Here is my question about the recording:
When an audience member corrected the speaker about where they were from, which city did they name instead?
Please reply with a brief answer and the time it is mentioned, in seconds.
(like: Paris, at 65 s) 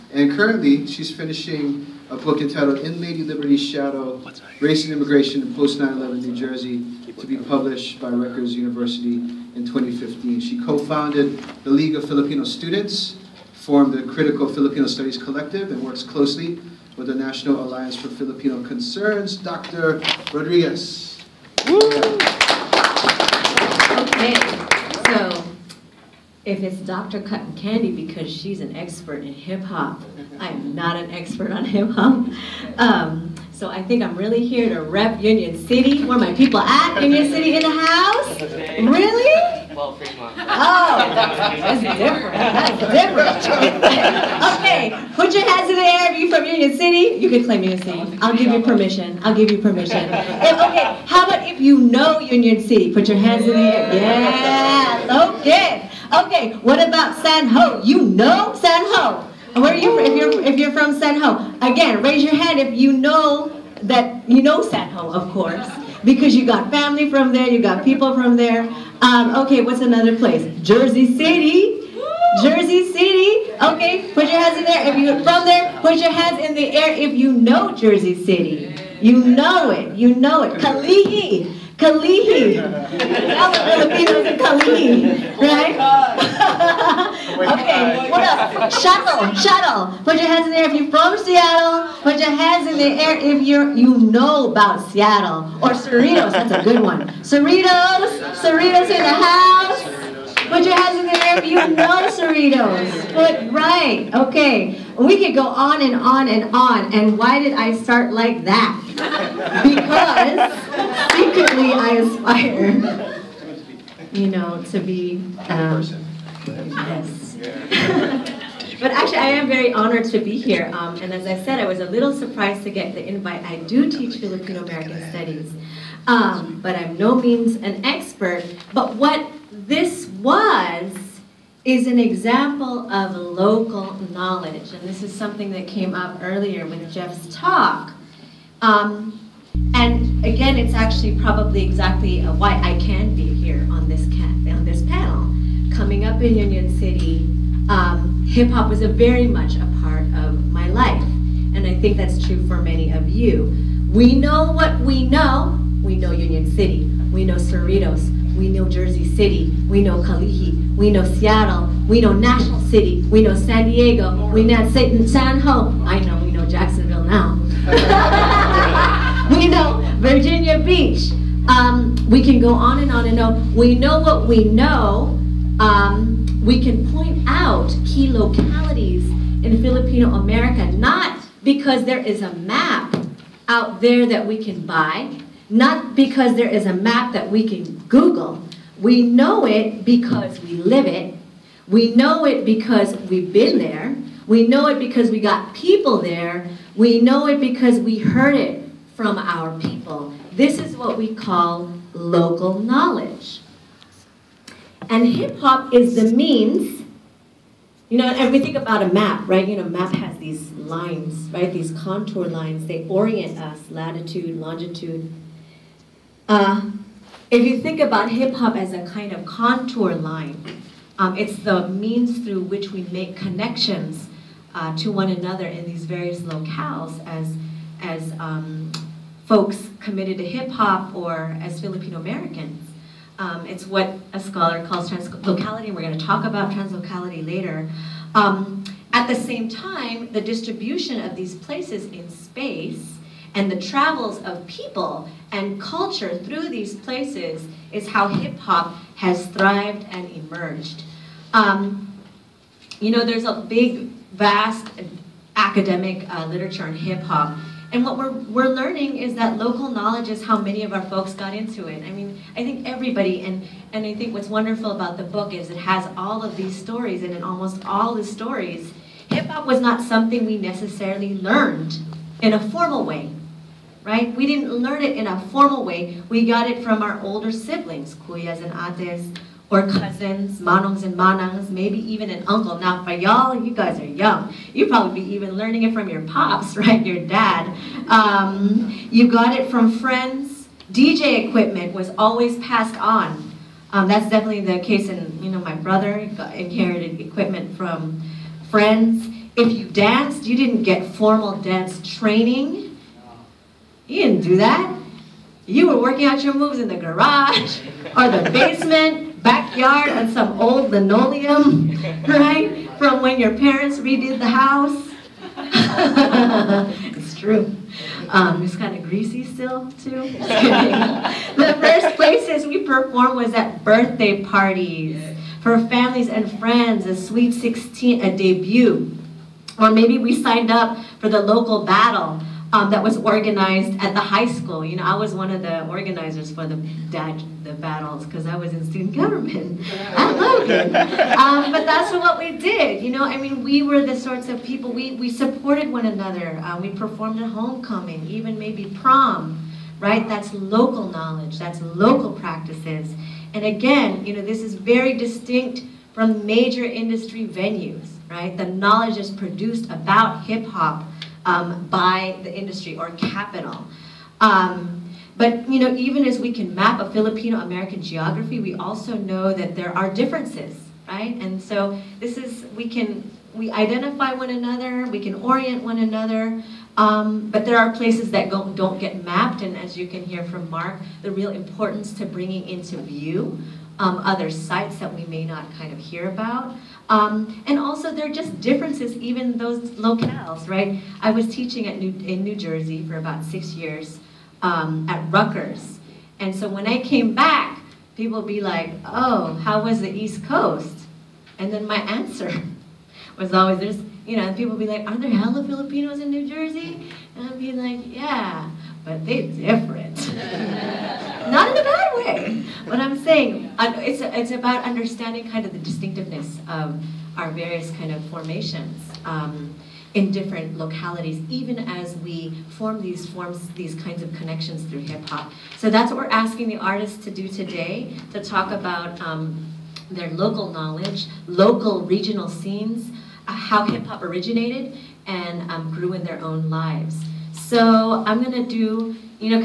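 Fremont, at 39 s.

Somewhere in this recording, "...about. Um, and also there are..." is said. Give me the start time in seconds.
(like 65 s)
386 s.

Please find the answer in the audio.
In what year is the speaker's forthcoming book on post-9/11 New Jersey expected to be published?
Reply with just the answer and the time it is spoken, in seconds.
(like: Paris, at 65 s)
2015, at 9 s.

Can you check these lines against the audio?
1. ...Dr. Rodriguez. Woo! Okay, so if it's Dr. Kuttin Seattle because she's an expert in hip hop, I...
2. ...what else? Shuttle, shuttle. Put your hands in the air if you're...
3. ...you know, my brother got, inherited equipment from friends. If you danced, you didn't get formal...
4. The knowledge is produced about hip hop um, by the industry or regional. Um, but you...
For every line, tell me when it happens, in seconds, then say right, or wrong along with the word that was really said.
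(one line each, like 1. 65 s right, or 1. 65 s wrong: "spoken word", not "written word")
1. 19 s wrong: "Kandi", not "Seattle"
2. 88 s right
3. 295 s right
4. 358 s wrong: "capital", not "regional".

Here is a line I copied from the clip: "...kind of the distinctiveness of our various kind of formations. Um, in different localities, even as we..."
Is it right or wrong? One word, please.
right.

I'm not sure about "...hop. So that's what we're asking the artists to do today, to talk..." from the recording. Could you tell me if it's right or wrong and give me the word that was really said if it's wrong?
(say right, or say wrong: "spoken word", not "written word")
right.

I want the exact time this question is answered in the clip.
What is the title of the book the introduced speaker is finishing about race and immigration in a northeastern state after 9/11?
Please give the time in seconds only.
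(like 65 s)
2 s.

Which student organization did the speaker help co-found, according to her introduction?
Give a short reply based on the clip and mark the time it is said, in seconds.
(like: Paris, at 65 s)
League of Filipino Students, at 11 s.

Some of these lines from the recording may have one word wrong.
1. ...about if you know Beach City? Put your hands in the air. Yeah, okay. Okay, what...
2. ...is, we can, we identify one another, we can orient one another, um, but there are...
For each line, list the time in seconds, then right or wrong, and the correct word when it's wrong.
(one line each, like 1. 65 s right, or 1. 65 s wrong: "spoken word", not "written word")
1. 51 s wrong: "Union", not "Beach"
2. 372 s right.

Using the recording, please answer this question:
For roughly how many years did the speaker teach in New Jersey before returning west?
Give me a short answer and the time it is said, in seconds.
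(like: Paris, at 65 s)
6, at 393 s.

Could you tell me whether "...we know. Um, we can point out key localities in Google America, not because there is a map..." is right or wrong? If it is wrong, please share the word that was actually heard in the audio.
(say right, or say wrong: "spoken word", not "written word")
wrong: "Filipino", not "Google".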